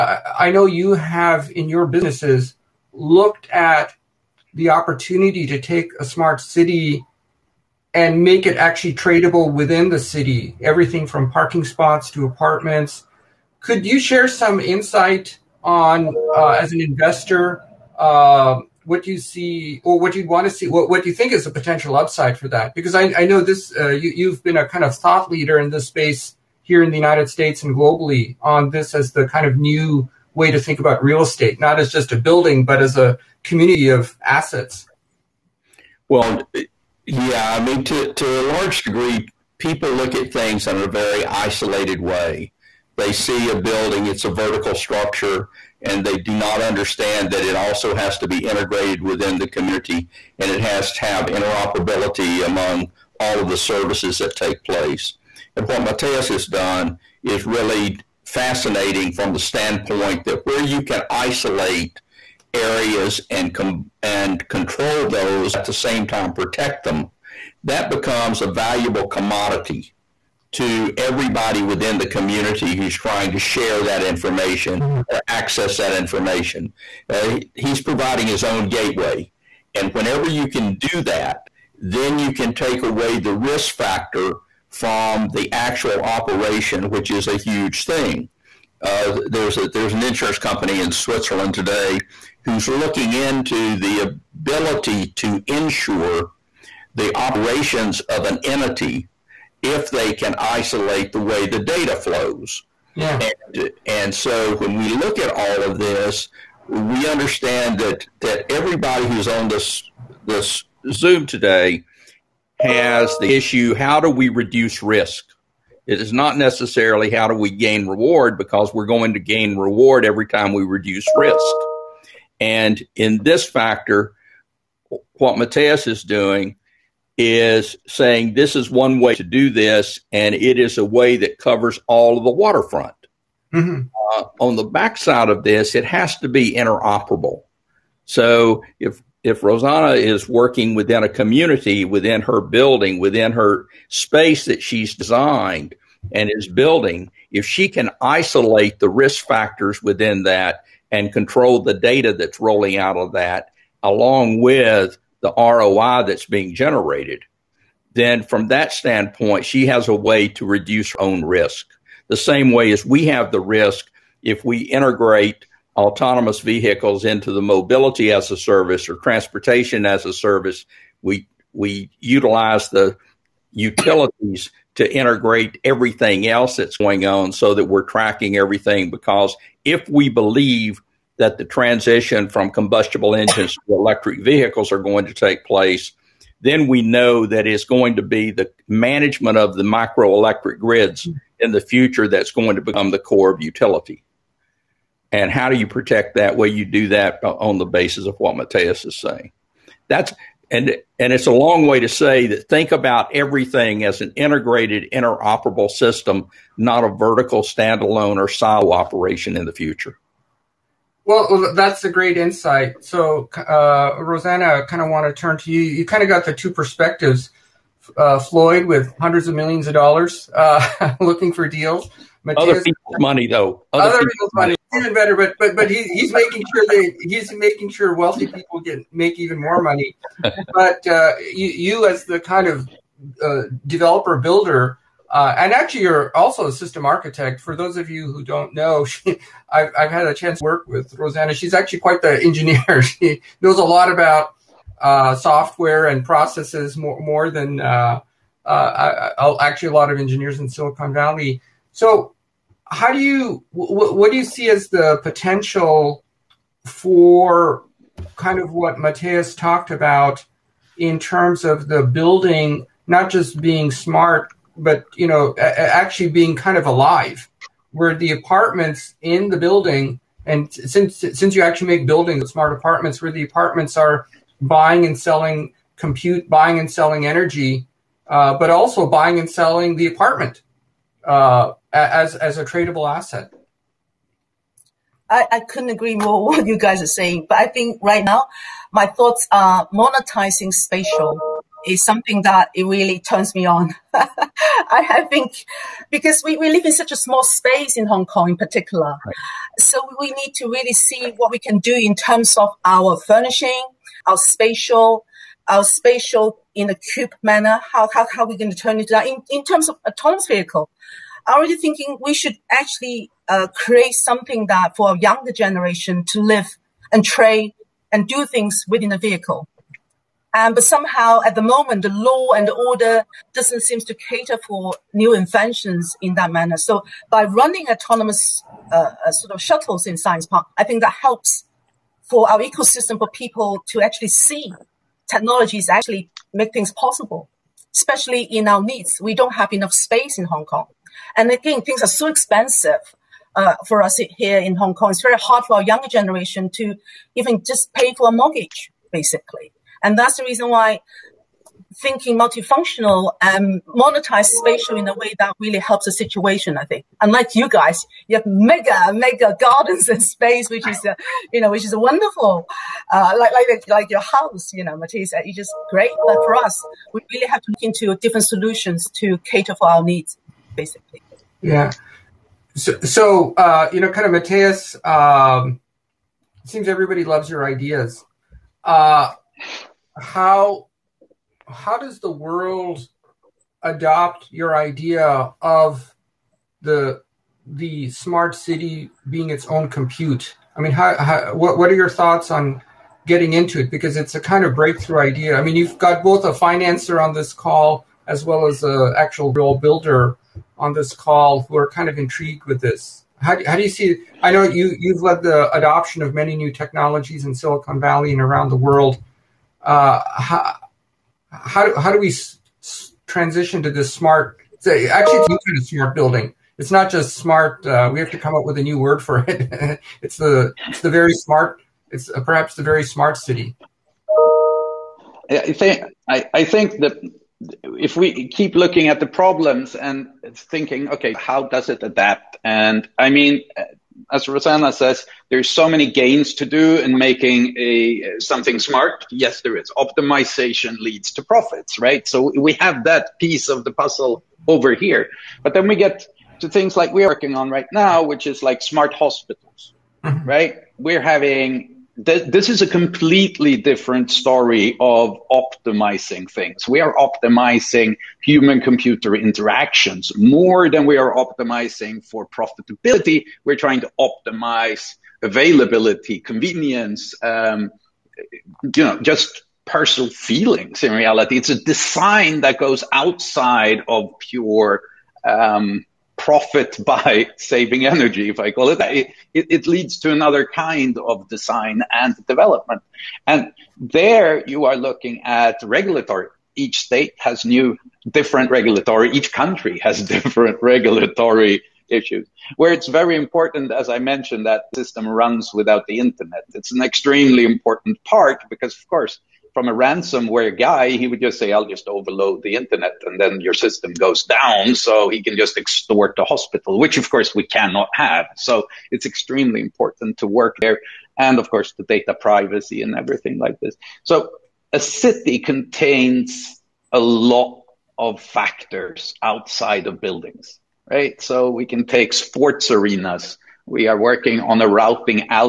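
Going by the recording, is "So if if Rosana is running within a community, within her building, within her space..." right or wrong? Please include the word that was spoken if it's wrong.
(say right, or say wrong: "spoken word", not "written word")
wrong: "working", not "running".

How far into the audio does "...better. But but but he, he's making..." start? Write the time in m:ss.
3:44.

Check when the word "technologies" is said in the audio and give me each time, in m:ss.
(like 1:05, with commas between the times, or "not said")
5:35, 6:46.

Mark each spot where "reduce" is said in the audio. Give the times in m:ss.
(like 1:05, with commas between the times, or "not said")
1:54, 2:00, 2:40.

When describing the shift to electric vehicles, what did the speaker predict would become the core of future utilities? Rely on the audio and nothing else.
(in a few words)
microelectric grids.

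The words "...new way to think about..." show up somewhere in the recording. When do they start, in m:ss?
0:29.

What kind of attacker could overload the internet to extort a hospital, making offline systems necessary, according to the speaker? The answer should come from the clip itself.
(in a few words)
ransomware guy.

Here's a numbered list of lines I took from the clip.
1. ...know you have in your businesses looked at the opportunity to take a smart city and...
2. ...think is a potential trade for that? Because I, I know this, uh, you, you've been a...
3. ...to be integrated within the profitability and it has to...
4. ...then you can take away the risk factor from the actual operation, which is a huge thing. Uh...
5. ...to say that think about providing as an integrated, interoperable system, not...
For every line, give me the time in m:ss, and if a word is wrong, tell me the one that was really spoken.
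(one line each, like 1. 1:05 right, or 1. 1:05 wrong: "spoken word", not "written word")
1. 0:00 right
2. 0:21 wrong: "upside", not "trade"
3. 0:48 wrong: "community", not "profitability"
4. 1:21 right
5. 3:21 wrong: "everything", not "providing".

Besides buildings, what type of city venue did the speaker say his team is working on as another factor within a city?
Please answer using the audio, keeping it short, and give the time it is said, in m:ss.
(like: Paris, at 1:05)
sports arenas, at 8:42.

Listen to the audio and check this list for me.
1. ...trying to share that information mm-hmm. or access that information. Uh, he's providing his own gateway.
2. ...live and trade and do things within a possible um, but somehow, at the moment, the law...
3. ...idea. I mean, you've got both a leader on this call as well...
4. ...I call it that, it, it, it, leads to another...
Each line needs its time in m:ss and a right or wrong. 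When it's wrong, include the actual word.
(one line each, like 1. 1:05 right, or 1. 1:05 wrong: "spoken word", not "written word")
1. 1:12 right
2. 5:16 wrong: "vehicle", not "possible"
3. 6:35 wrong: "financer", not "leader"
4. 7:58 right.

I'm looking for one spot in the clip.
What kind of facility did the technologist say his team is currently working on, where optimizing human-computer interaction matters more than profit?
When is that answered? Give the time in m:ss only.
7:28.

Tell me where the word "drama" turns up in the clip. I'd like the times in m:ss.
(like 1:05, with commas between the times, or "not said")
not said.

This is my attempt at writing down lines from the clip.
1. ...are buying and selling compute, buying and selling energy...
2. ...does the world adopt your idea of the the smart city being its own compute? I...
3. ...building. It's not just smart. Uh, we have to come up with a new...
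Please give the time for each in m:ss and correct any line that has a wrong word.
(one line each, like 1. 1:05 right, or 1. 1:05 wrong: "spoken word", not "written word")
1. 4:33 right
2. 6:21 right
3. 6:55 right.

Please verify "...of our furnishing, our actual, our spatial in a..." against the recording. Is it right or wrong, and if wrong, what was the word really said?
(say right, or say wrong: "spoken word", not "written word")
wrong: "spatial", not "actual".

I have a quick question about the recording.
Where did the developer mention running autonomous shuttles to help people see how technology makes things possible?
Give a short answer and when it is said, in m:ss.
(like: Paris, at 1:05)
Science Park, at 5:29.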